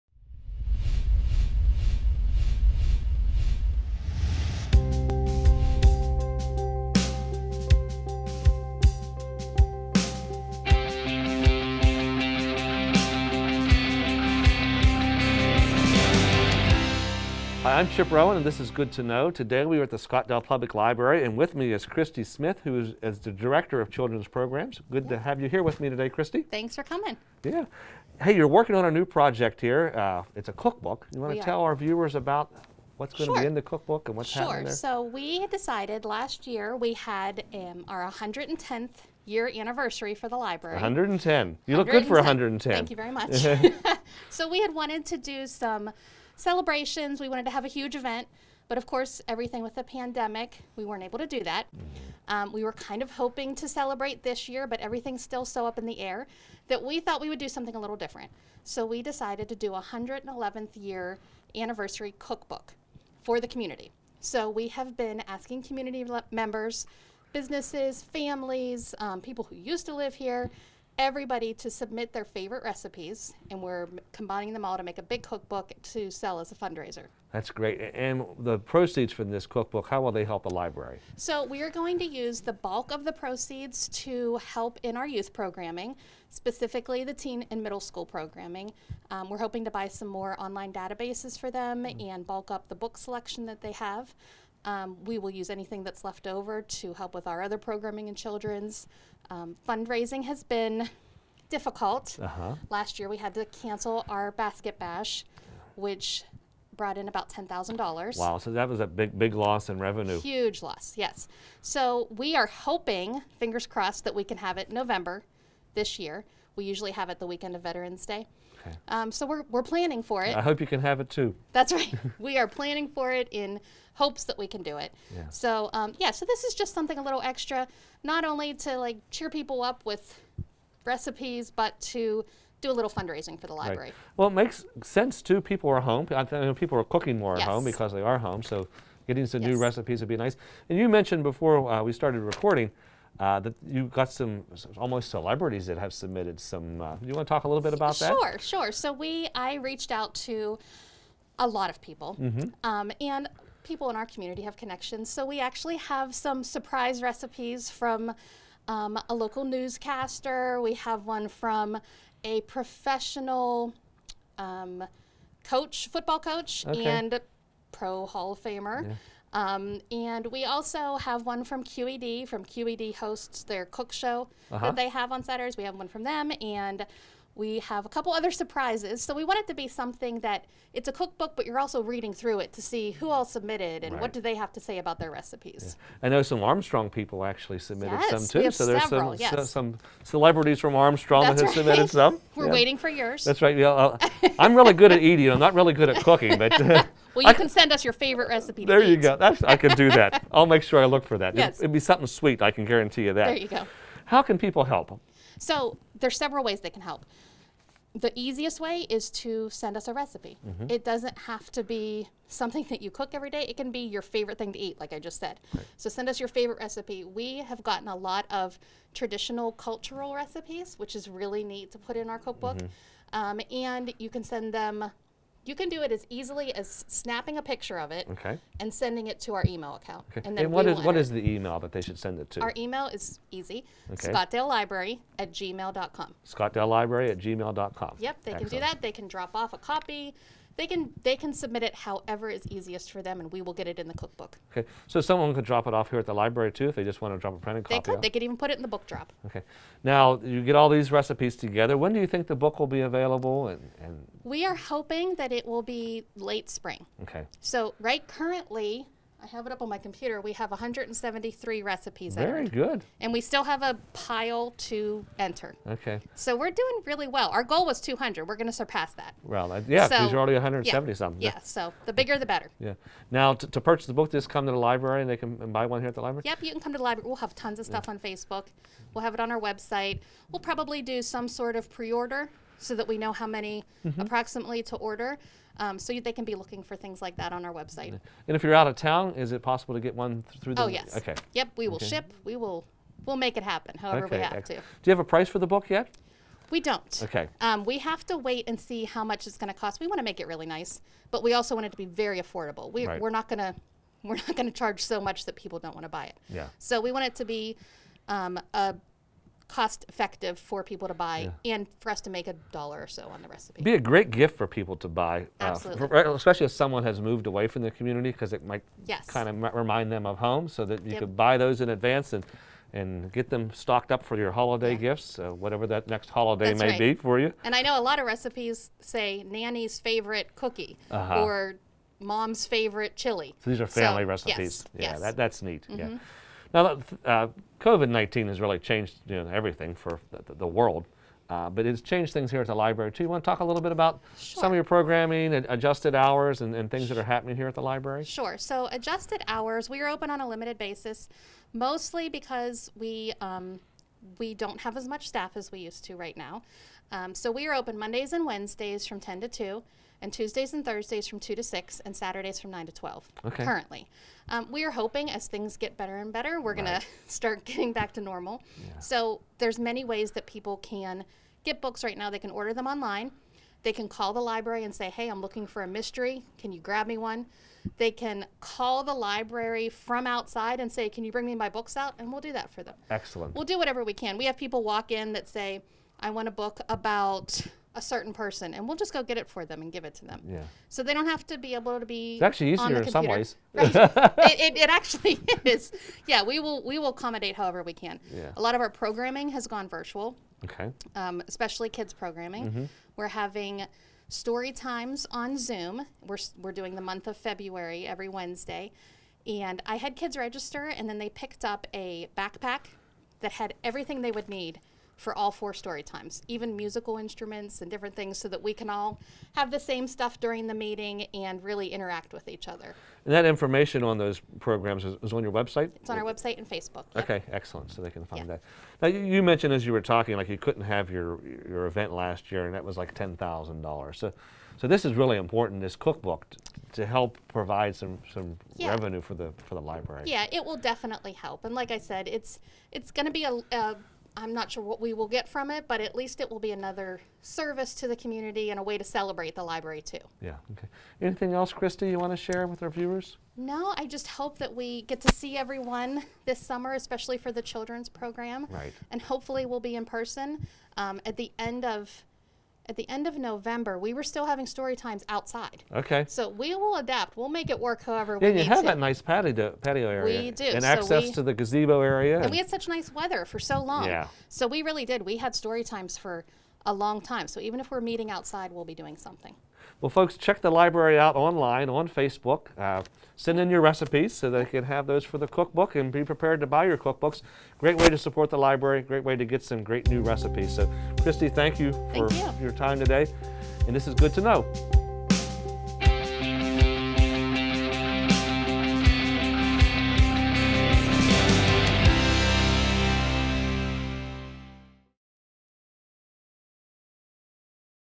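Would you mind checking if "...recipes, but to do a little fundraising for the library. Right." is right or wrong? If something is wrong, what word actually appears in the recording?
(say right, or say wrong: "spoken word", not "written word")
right.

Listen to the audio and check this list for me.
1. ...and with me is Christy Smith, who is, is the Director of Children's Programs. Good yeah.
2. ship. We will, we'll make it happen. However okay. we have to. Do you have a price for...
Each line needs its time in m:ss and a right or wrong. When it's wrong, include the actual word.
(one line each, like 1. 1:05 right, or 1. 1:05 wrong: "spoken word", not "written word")
1. 0:21 right
2. 4:51 right.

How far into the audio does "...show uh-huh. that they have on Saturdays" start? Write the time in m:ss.
2:53.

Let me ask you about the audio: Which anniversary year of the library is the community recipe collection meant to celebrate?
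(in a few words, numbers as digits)
111th.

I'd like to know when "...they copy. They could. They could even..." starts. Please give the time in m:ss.
4:07.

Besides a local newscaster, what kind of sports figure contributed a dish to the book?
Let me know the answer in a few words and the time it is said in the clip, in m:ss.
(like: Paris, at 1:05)
football coach, at 2:45.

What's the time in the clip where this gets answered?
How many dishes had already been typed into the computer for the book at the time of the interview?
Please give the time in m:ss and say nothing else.
4:20.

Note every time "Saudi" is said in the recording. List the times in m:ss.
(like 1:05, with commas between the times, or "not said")
not said.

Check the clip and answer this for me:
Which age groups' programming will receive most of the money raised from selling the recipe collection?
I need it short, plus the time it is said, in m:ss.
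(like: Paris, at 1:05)
teen and middle school, at 1:27.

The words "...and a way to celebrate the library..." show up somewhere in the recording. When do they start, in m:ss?
7:28.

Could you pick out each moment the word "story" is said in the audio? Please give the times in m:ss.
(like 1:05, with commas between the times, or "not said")
6:44, 6:55, 7:44, 7:55.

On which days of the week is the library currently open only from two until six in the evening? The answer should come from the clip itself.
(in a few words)
Tuesdays and Thursdays.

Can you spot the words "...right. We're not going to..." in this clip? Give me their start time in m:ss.
5:02.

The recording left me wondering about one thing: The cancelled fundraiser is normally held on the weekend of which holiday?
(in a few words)
Veterans Day.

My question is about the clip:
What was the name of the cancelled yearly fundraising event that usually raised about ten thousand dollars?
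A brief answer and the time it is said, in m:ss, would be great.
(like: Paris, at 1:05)
basket bash, at 1:44.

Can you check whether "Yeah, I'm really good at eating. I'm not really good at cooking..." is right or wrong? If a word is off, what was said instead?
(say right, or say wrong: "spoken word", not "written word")
right.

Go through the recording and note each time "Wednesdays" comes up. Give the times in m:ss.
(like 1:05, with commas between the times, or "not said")
5:58, 6:48.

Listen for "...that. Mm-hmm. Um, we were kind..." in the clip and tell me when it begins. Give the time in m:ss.
0:51.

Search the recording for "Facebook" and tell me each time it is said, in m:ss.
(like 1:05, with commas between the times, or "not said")
4:37, 7:06, 8:01.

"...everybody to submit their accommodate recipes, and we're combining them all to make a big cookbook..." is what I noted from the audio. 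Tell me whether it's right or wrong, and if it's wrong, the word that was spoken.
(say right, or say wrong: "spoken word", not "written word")
wrong: "favorite", not "accommodate".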